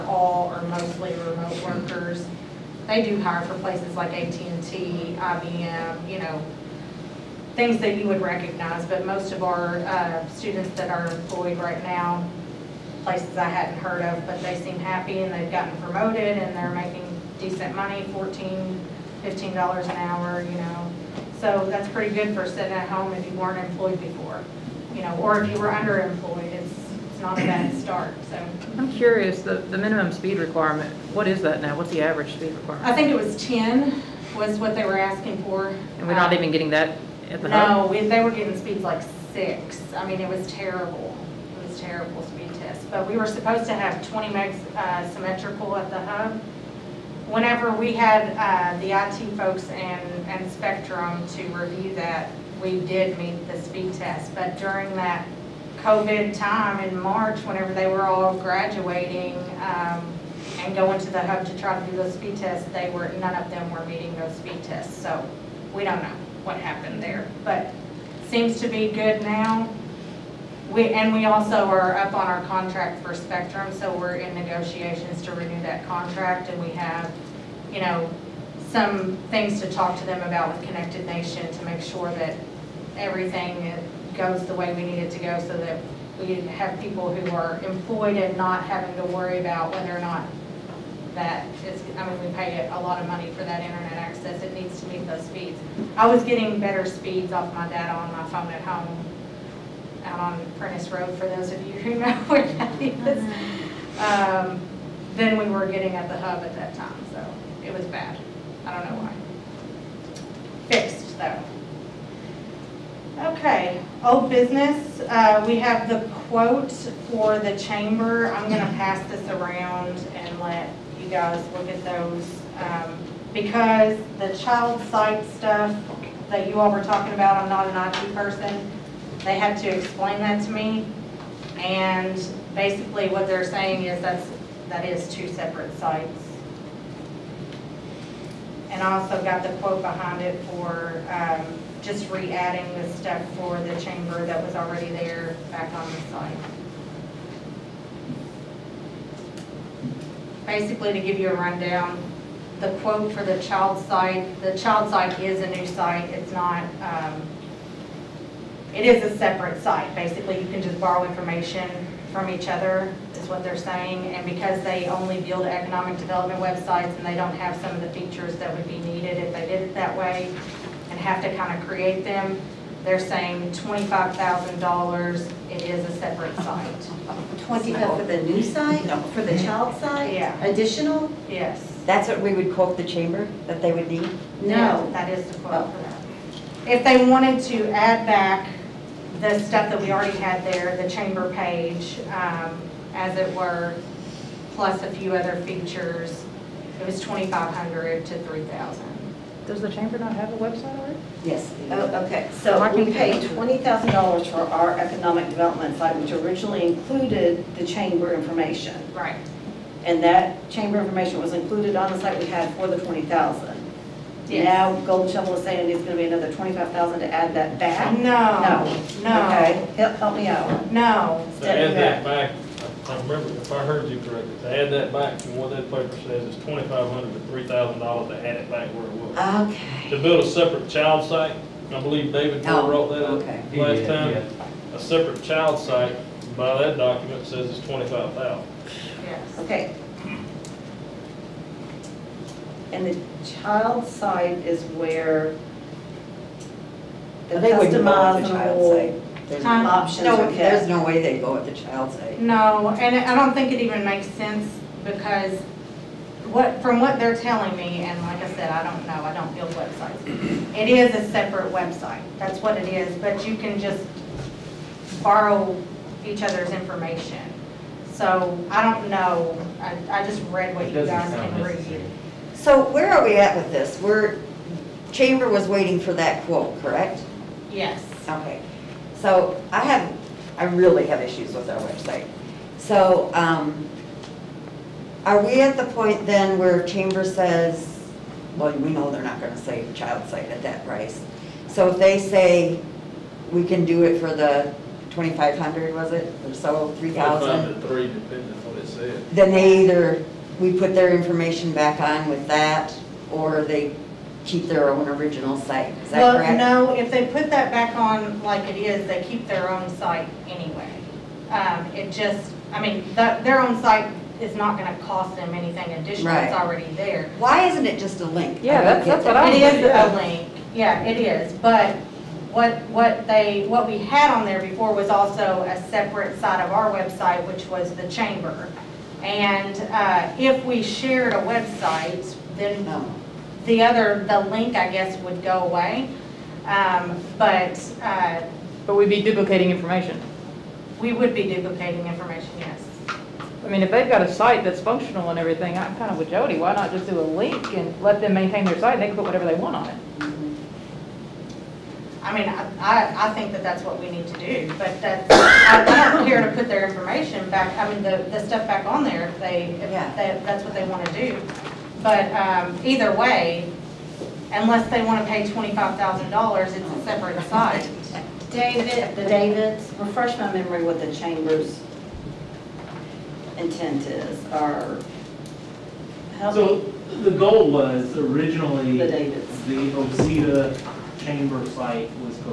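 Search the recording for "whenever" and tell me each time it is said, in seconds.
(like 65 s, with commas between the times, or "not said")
47 s, 57 s.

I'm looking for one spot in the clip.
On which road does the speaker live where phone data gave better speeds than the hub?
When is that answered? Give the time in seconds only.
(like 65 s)
100 s.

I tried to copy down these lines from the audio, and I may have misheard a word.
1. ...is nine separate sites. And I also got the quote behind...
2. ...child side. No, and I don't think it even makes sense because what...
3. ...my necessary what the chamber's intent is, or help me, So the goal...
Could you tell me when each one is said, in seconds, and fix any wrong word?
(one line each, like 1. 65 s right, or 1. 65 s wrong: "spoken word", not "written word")
1. 134 s wrong: "two", not "nine"
2. 251 s right
3. 370 s wrong: "memory", not "necessary".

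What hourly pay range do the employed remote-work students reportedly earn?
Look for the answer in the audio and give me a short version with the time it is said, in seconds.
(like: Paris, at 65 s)
$14-$15 an hour, at 18 s.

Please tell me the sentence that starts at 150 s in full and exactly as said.
Basically, to give you a rundown, the quote for the child site, the child site is a new site.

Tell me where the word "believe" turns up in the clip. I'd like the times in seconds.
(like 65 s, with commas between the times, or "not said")
231 s.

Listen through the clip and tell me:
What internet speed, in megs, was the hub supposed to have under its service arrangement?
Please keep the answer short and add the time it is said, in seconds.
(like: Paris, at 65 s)
20 megs symmetrical, at 44 s.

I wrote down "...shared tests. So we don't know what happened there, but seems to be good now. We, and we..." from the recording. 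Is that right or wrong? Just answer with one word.
wrong.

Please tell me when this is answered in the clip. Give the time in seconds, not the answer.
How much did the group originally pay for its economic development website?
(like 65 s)
203 s.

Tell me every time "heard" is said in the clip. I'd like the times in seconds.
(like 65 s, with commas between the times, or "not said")
13 s, 223 s.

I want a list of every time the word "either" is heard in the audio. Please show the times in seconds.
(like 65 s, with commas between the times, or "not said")
299 s, 362 s.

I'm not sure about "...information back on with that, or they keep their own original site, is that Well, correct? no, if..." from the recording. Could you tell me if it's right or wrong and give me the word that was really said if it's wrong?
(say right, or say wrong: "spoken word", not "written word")
right.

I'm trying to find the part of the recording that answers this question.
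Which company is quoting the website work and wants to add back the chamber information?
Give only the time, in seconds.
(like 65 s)
214 s.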